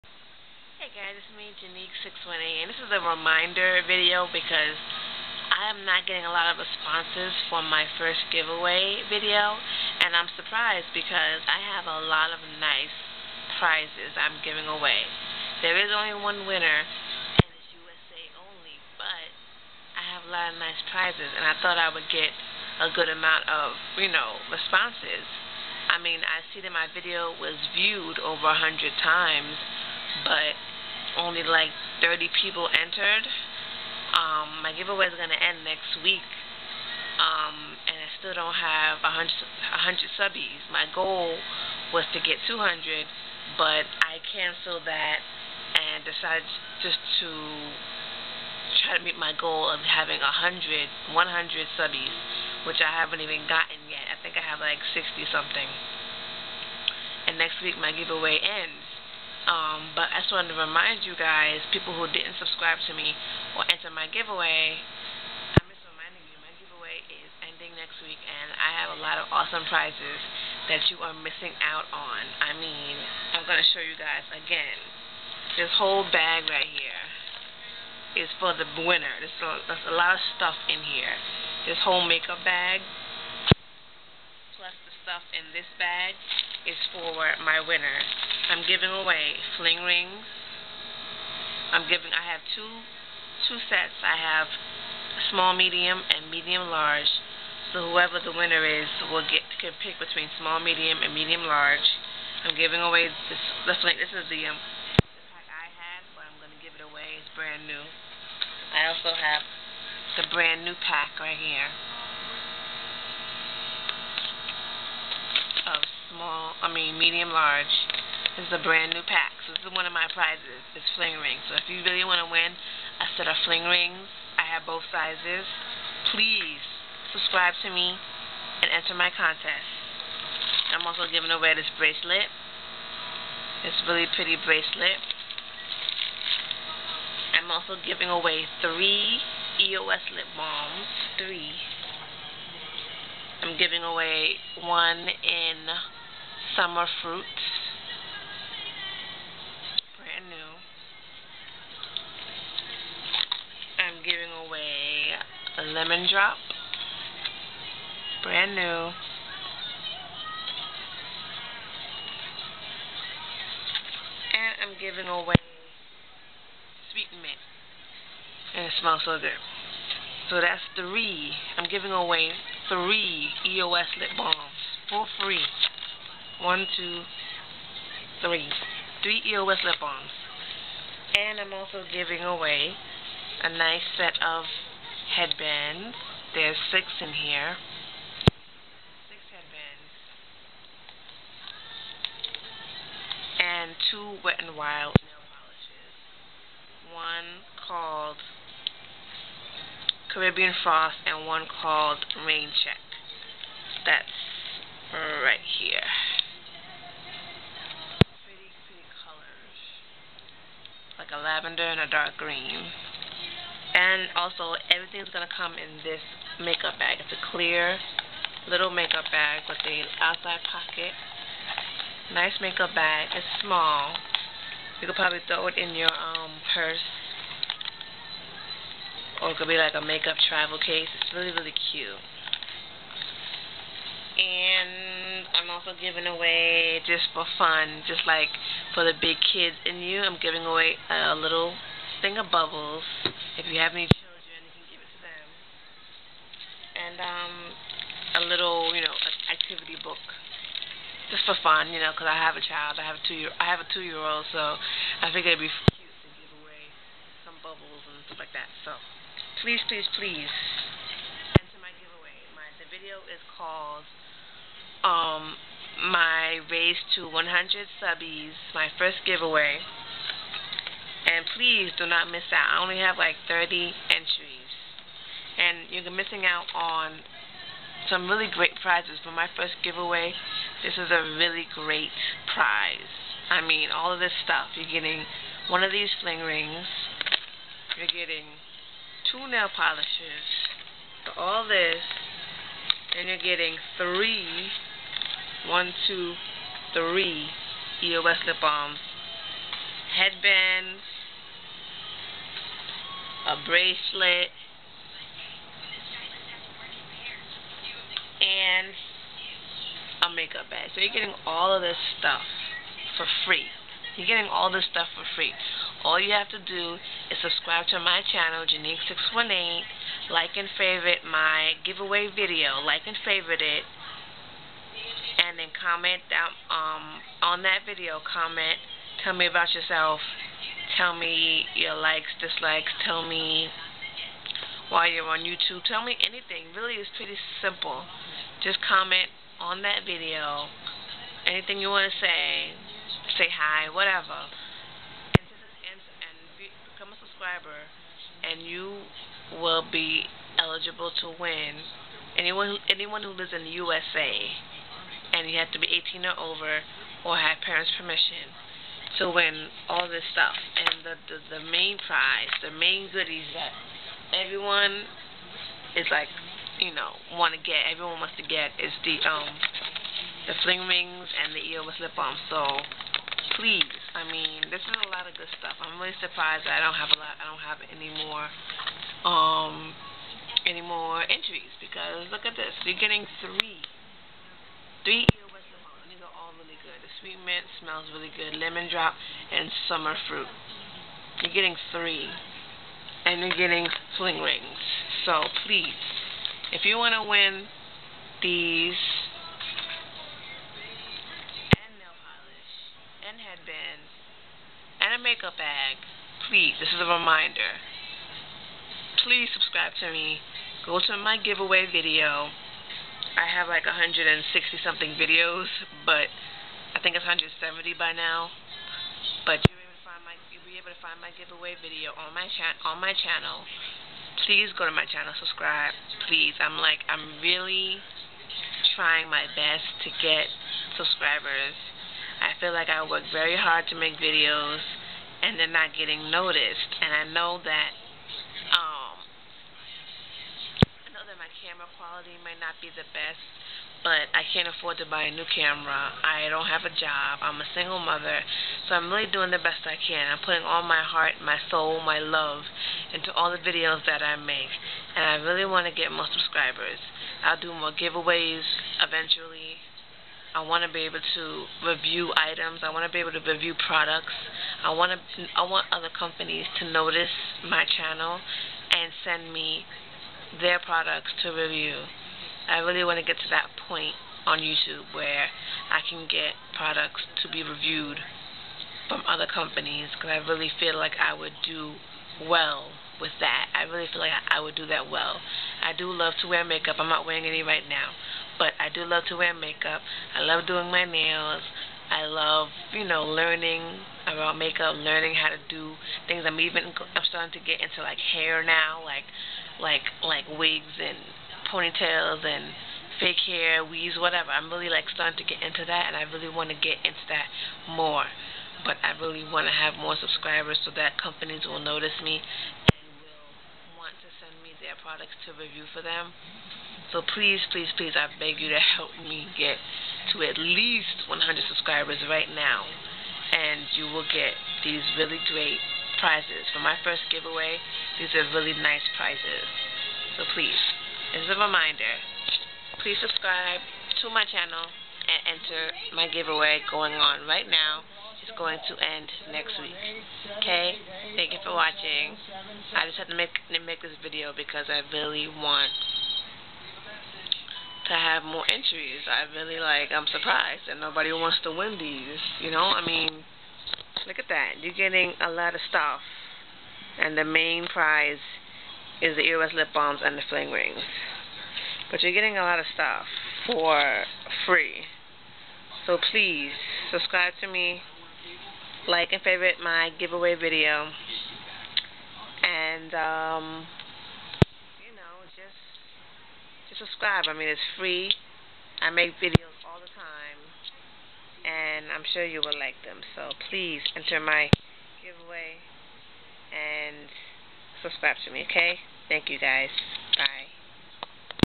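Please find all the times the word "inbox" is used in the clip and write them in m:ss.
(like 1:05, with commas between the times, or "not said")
not said.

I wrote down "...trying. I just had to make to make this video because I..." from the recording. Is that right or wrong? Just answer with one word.
wrong.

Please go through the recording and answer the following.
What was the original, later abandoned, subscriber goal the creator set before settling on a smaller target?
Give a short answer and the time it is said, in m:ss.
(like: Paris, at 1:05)
200, at 0:40.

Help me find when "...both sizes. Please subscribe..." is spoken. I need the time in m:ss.
2:04.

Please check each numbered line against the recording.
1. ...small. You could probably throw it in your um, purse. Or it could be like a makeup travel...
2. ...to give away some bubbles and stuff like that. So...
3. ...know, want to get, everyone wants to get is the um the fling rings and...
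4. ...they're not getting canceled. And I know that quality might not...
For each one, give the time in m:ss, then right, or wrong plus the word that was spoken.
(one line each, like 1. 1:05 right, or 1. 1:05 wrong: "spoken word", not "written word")
1. 3:43 right
2. 4:16 right
3. 6:06 right
4. 7:15 wrong: "noticed", not "canceled".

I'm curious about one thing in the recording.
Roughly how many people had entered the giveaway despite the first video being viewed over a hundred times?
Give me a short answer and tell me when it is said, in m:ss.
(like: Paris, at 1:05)
30, at 0:31.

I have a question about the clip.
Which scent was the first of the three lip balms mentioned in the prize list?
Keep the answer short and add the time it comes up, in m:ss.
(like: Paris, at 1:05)
summer fruits, at 2:24.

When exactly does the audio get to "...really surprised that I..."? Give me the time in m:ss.
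6:15.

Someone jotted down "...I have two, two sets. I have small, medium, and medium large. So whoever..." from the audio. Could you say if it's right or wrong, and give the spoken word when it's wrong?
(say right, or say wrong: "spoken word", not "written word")
right.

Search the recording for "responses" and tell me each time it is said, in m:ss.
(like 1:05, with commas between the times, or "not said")
0:06, 0:24.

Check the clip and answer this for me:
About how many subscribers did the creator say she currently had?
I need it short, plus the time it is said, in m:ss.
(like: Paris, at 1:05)
60 something, at 0:54.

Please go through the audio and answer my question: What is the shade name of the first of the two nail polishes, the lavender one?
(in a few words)
Caribbean Frost.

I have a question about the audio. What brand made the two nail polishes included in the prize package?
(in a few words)
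Wet n Wild.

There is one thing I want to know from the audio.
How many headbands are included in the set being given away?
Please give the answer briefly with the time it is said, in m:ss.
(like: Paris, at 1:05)
6, at 3:06.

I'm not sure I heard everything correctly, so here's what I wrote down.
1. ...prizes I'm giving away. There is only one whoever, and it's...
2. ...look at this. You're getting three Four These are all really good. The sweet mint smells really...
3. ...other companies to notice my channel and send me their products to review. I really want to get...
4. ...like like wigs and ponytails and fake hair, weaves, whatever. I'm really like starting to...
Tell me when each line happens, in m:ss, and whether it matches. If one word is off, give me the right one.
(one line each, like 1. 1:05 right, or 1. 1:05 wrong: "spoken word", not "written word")
1. 0:13 wrong: "winner", not "whoever"
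2. 6:22 wrong: "Three", not "Four"
3. 7:45 right
4. 8:19 right.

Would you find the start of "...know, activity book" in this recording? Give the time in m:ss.
4:08.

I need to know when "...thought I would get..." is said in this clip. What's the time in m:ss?
0:21.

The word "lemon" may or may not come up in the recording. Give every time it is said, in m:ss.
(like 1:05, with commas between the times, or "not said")
2:35, 6:28.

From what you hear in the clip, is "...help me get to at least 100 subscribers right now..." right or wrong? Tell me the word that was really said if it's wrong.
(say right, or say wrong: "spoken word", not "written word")
right.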